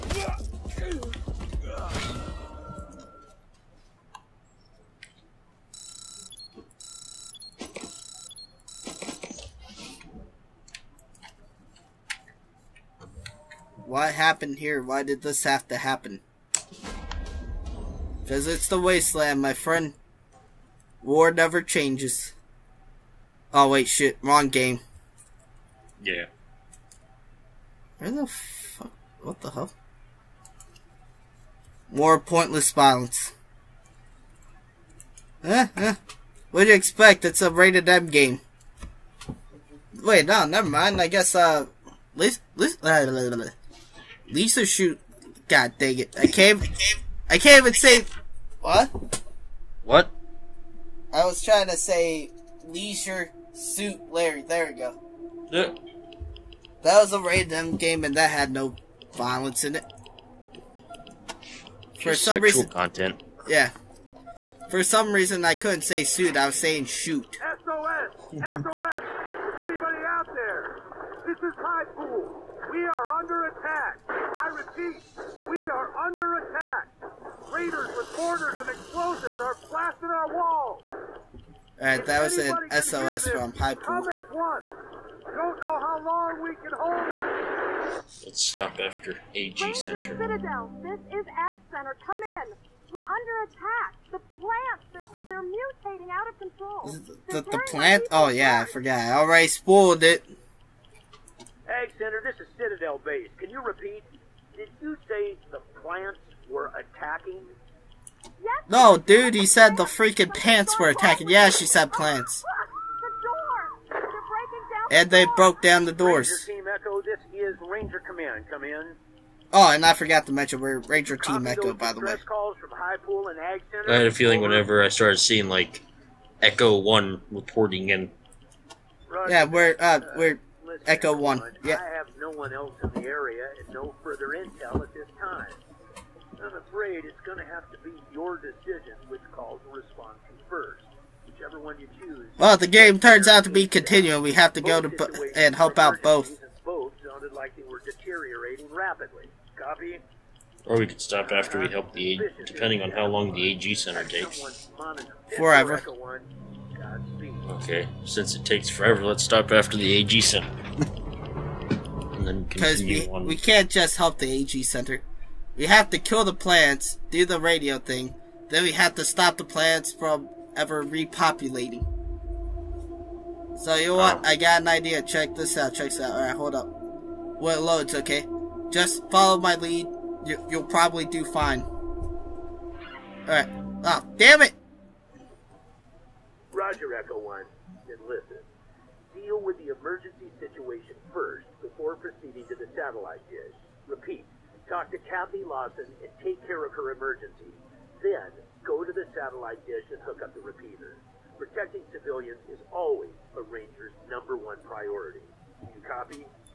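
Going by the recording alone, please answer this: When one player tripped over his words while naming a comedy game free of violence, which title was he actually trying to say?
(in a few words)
Leisure Suit Larry.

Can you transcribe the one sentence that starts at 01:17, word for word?
Raiders with mortars and explosives are blasting our walls.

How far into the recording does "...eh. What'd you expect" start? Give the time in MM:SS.
00:35.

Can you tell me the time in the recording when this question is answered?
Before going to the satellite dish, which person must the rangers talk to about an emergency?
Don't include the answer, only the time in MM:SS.
03:15.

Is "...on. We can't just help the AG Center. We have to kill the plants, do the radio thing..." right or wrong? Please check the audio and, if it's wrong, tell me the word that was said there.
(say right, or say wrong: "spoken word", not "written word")
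right.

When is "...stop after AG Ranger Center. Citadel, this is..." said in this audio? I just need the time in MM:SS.
01:28.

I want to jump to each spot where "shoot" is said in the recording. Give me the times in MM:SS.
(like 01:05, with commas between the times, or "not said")
00:44, 01:06.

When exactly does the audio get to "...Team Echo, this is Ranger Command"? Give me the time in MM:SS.
01:56.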